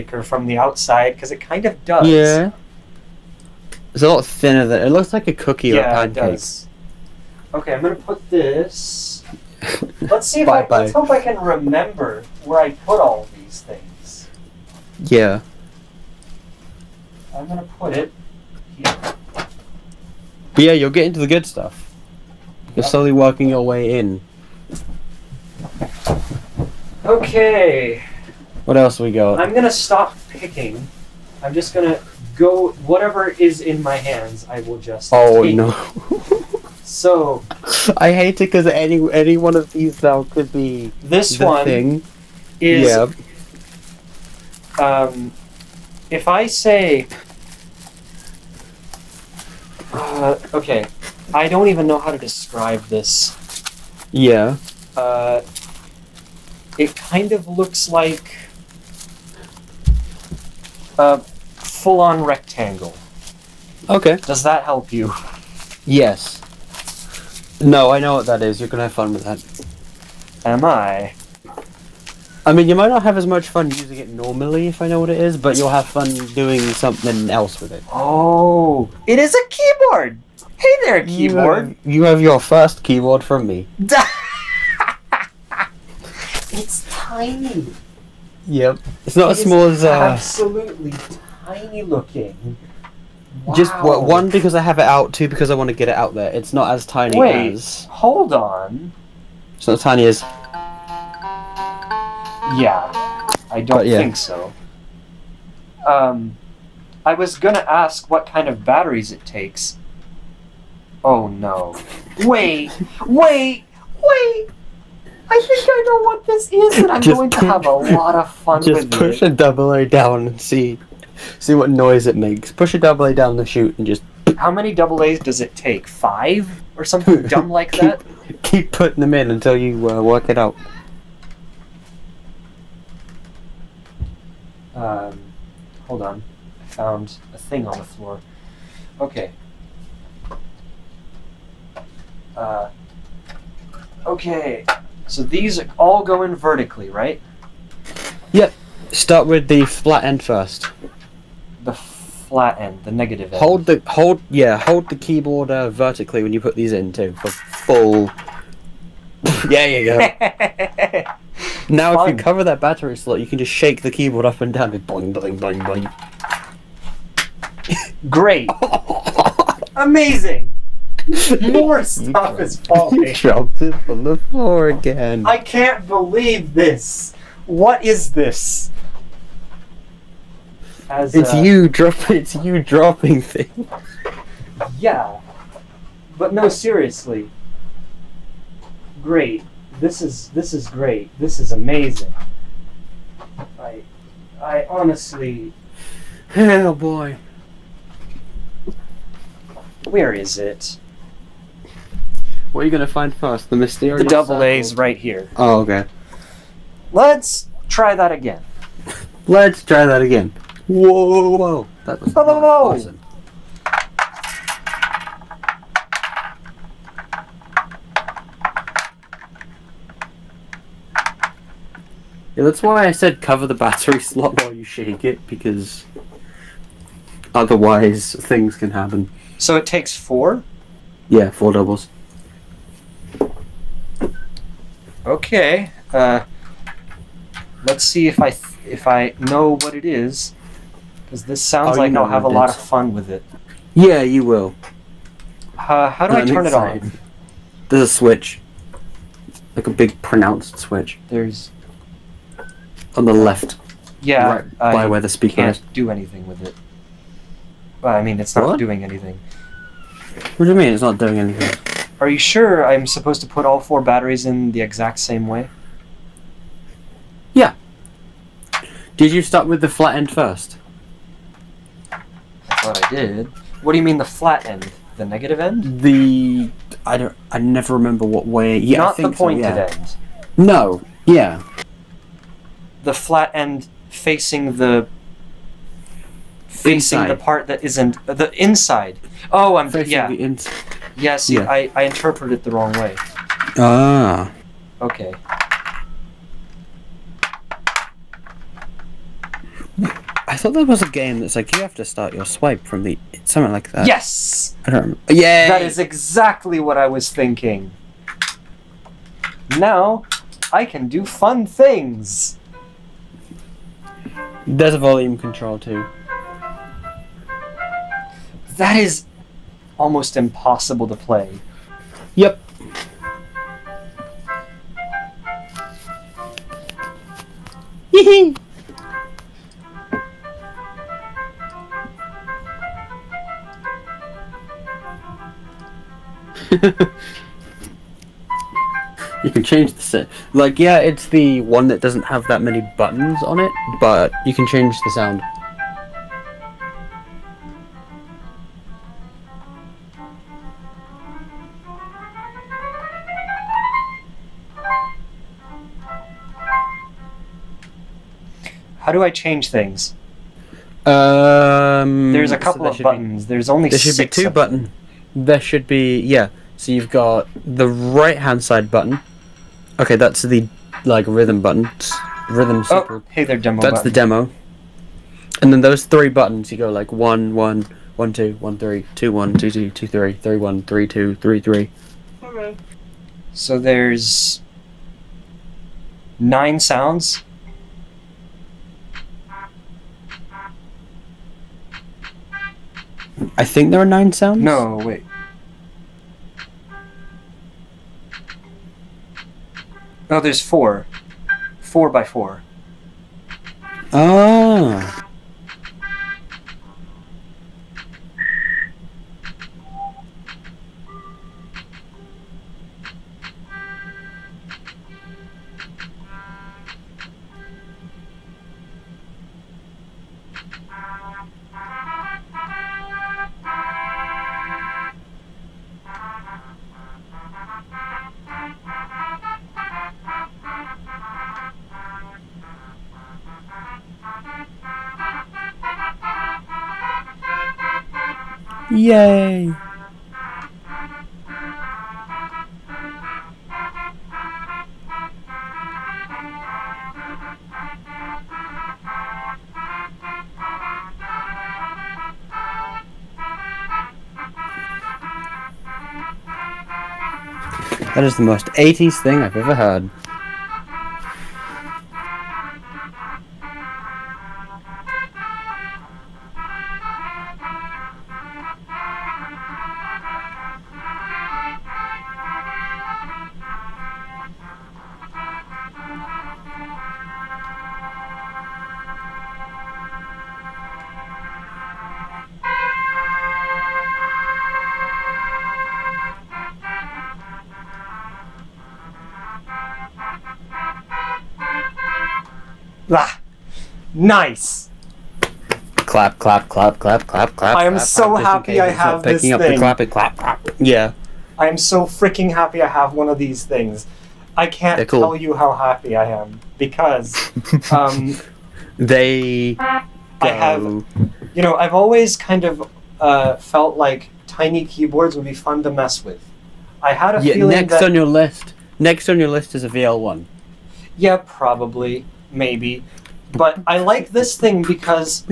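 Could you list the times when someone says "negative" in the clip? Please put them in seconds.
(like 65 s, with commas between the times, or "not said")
152 s, 275 s.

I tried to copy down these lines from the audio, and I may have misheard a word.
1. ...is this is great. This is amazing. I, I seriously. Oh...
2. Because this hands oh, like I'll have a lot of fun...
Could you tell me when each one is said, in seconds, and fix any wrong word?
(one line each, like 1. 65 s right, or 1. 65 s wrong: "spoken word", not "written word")
1. 190 s wrong: "honestly", not "seriously"
2. 241 s wrong: "sounds", not "hands".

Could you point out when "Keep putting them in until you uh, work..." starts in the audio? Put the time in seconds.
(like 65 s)
128 s.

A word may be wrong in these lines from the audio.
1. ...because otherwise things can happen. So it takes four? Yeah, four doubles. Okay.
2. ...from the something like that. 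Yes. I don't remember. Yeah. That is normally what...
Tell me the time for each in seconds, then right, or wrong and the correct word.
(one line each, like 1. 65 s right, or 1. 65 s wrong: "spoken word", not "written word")
1. 225 s right
2. 302 s wrong: "exactly", not "normally".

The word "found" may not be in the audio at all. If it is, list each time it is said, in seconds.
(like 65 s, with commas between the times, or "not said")
136 s.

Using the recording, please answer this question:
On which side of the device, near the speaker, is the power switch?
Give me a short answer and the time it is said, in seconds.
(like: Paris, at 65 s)
Left, at 252 s.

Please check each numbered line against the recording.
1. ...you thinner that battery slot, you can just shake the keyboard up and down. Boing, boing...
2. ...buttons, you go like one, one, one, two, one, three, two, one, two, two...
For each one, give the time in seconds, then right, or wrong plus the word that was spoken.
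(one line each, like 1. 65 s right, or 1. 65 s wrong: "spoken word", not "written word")
1. 162 s wrong: "cover", not "thinner"
2. 376 s right.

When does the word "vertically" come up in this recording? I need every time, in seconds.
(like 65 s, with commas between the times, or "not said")
146 s, 155 s.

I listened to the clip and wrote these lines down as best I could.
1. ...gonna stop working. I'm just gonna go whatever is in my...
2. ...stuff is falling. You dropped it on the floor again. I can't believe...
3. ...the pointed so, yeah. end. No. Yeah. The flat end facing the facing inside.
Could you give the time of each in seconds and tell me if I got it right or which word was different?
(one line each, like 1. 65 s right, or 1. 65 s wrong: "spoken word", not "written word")
1. 29 s wrong: "picking", not "working"
2. 171 s right
3. 278 s right.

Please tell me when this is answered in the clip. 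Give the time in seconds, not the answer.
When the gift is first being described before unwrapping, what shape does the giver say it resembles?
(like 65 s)
60 s.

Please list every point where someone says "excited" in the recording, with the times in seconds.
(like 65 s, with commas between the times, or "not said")
246 s.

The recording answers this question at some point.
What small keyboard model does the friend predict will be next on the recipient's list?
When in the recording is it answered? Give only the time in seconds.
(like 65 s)
519 s.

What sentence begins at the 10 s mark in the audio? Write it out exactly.
let's hope I can remember where I put all these things.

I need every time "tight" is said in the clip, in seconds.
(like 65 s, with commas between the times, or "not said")
not said.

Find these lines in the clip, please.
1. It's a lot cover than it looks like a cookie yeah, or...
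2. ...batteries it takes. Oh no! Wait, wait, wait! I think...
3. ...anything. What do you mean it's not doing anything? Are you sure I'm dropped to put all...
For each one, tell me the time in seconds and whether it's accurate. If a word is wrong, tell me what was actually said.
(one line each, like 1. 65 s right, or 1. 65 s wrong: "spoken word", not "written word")
1. 3 s wrong: "thinner", not "cover"
2. 108 s right
3. 258 s wrong: "supposed", not "dropped".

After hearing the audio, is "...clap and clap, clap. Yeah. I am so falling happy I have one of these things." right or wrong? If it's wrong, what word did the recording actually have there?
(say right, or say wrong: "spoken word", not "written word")
wrong: "freaking", not "falling".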